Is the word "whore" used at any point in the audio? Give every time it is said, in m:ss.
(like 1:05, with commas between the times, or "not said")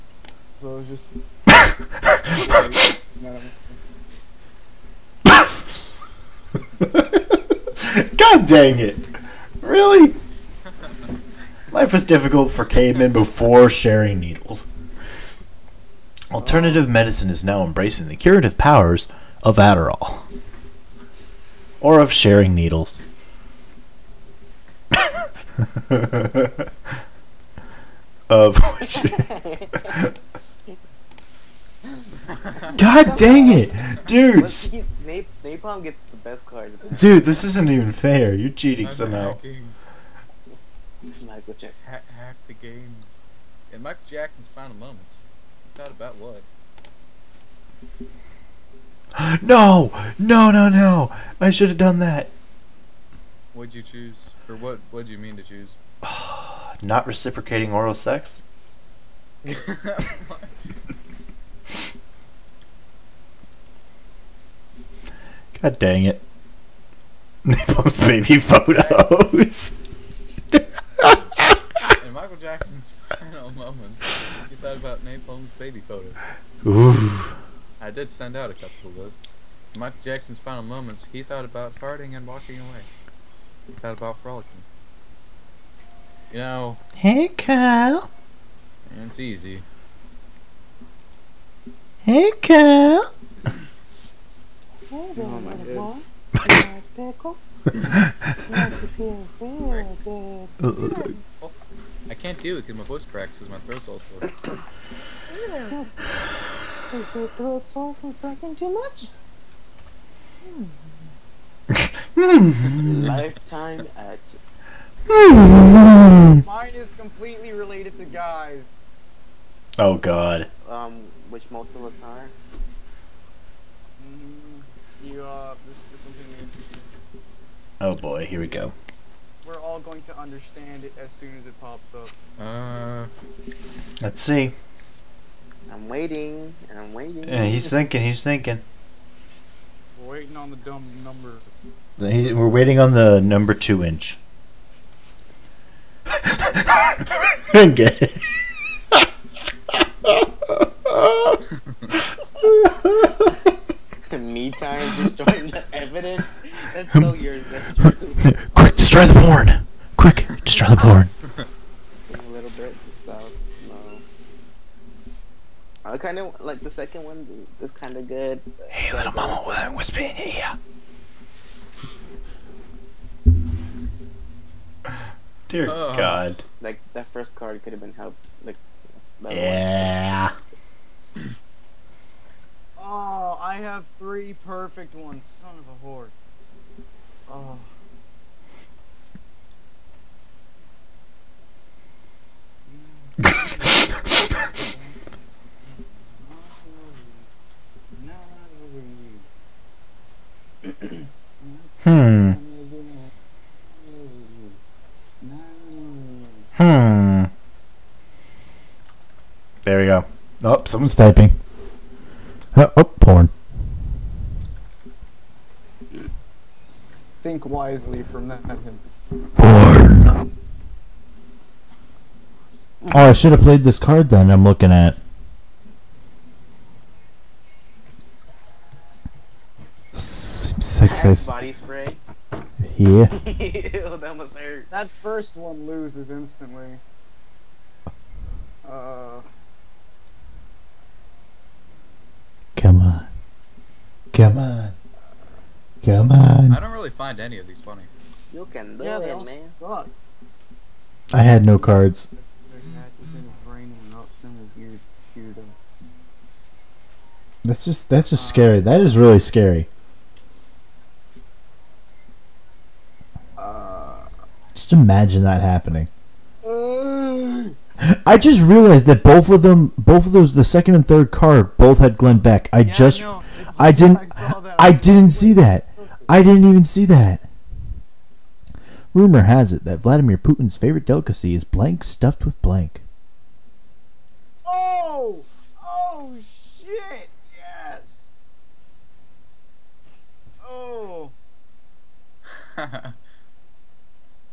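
3:05.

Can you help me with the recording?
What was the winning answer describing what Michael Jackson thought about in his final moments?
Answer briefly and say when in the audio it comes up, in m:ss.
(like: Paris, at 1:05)
Napalm's baby photos, at 1:07.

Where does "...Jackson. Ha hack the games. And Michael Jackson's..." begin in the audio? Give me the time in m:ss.
0:41.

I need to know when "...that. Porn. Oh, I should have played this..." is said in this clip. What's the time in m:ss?
3:38.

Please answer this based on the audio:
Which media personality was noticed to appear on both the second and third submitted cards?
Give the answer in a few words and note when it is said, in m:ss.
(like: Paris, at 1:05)
Glenn Beck, at 4:31.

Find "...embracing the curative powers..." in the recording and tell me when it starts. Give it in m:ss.
0:17.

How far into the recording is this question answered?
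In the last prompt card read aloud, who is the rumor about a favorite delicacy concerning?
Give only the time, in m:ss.
4:39.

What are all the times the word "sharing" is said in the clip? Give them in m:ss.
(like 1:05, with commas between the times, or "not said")
0:13, 0:22.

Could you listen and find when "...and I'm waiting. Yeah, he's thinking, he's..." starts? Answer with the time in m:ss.
2:16.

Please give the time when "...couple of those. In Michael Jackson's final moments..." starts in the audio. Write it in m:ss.
1:18.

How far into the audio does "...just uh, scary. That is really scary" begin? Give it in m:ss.
4:18.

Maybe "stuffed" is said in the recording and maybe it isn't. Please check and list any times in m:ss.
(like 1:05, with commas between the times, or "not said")
4:41.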